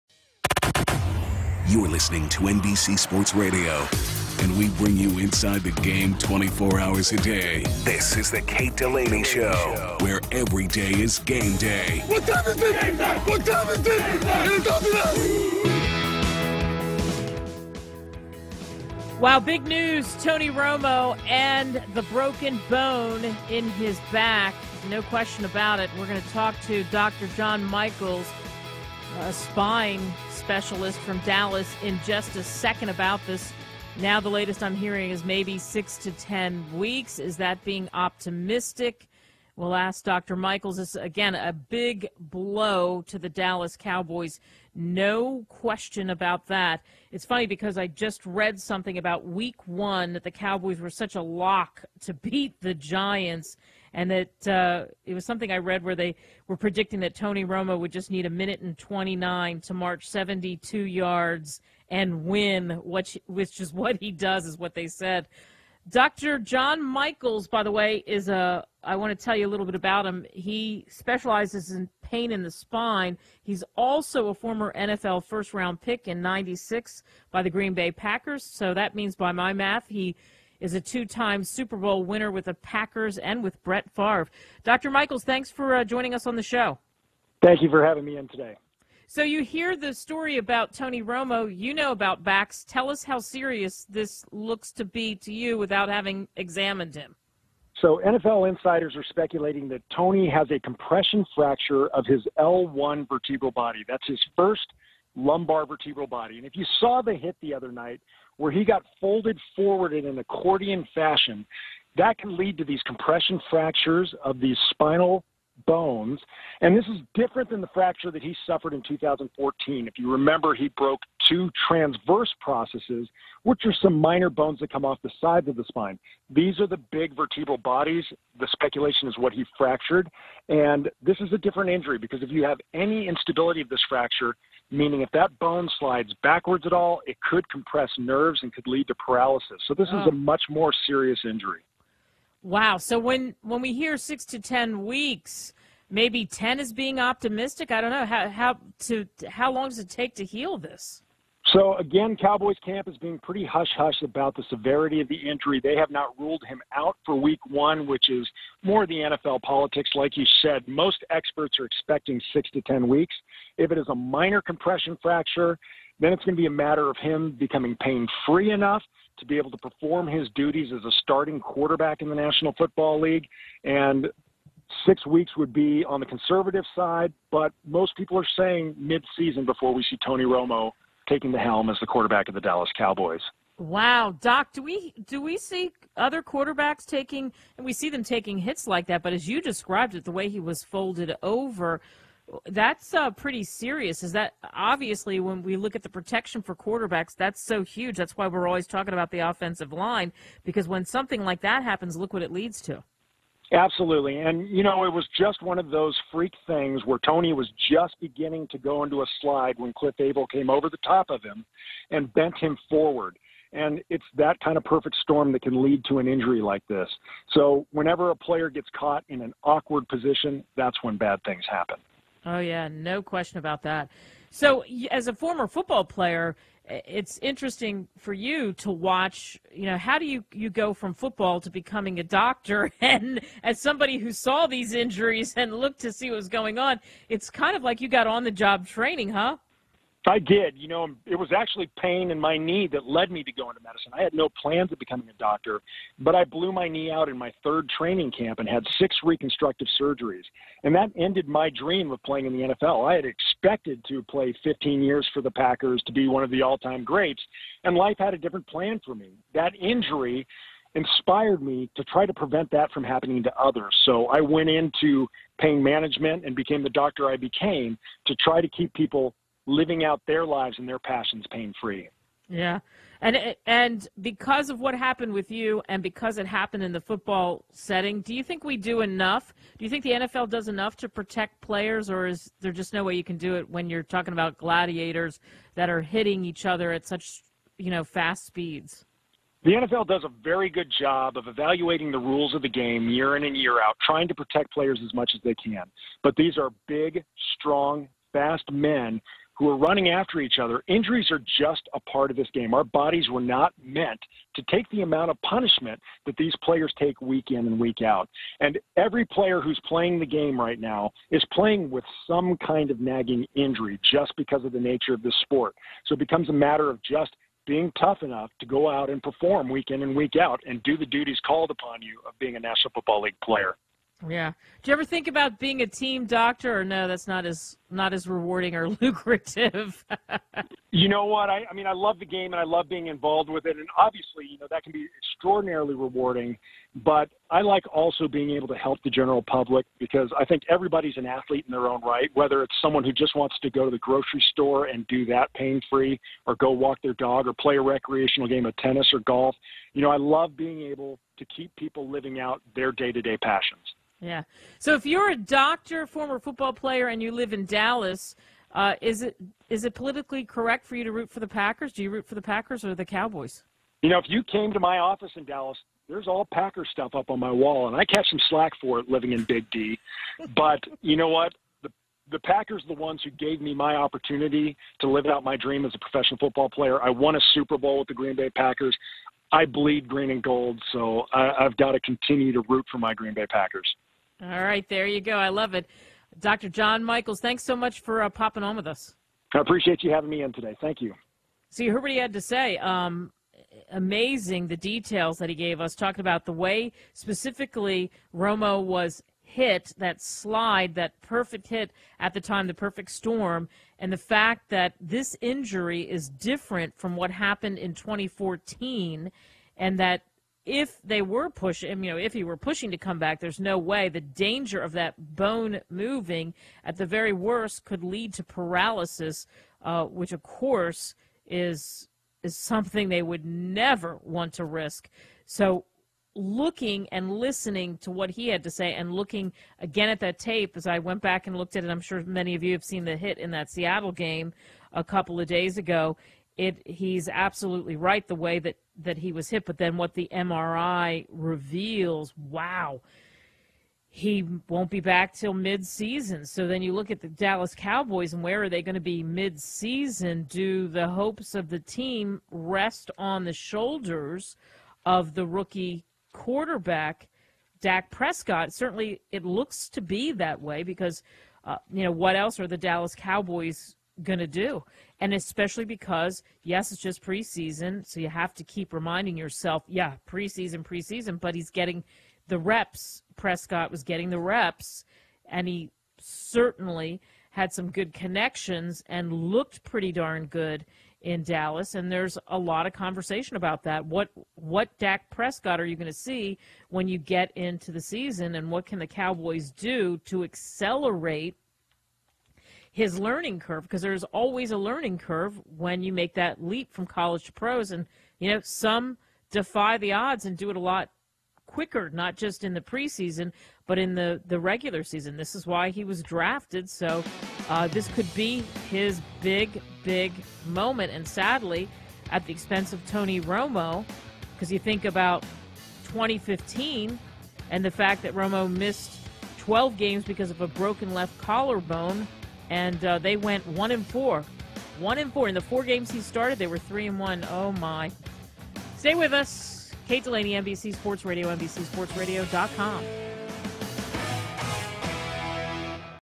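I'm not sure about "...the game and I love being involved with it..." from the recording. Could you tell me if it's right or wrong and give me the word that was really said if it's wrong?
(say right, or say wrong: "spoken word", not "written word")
right.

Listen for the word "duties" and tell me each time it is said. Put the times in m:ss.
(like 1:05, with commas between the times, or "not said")
2:50, 5:20.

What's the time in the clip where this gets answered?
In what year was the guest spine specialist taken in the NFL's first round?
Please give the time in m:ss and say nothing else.
1:16.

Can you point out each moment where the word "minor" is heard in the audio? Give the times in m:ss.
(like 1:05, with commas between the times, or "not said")
2:03, 2:43.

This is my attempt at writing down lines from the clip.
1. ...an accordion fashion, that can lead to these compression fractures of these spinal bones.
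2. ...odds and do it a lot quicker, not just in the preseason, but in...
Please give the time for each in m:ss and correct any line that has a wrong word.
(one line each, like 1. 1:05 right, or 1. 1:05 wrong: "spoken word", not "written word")
1. 1:50 right
2. 8:19 right.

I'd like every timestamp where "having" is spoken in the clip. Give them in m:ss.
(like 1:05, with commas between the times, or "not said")
1:27, 1:35, 6:29.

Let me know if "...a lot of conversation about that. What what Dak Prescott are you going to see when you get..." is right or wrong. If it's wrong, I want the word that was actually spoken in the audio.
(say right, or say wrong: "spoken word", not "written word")
right.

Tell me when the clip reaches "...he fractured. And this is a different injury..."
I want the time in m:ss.
2:09.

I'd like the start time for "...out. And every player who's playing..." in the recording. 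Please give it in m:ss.
5:07.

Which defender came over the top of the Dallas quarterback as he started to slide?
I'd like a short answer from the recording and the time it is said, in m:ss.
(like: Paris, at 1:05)
Cliff Avril, at 3:29.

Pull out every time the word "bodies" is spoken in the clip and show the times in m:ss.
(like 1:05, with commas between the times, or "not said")
2:07, 5:02.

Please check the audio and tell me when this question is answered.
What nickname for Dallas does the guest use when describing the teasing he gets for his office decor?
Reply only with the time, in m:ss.
6:09.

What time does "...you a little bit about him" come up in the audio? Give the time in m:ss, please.
1:09.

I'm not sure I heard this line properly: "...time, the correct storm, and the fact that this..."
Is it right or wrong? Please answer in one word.
wrong.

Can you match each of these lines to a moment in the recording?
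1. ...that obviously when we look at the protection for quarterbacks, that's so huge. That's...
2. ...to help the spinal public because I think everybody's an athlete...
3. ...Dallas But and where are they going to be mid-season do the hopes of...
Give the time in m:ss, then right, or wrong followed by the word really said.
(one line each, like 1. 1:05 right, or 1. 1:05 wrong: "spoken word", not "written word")
1. 3:14 right
2. 5:38 wrong: "general", not "spinal"
3. 7:27 wrong: "Cowboys", not "But".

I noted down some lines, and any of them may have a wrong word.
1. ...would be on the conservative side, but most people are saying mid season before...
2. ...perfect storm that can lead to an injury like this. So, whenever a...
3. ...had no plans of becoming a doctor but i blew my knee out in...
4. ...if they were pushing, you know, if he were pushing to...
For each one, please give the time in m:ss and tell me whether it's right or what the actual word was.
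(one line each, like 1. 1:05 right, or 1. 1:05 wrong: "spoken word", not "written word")
1. 2:55 right
2. 3:34 right
3. 4:04 right
4. 6:50 right.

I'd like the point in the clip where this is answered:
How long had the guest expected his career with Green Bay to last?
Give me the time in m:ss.
4:14.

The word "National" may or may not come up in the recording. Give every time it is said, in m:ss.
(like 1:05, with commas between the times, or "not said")
2:52, 5:22.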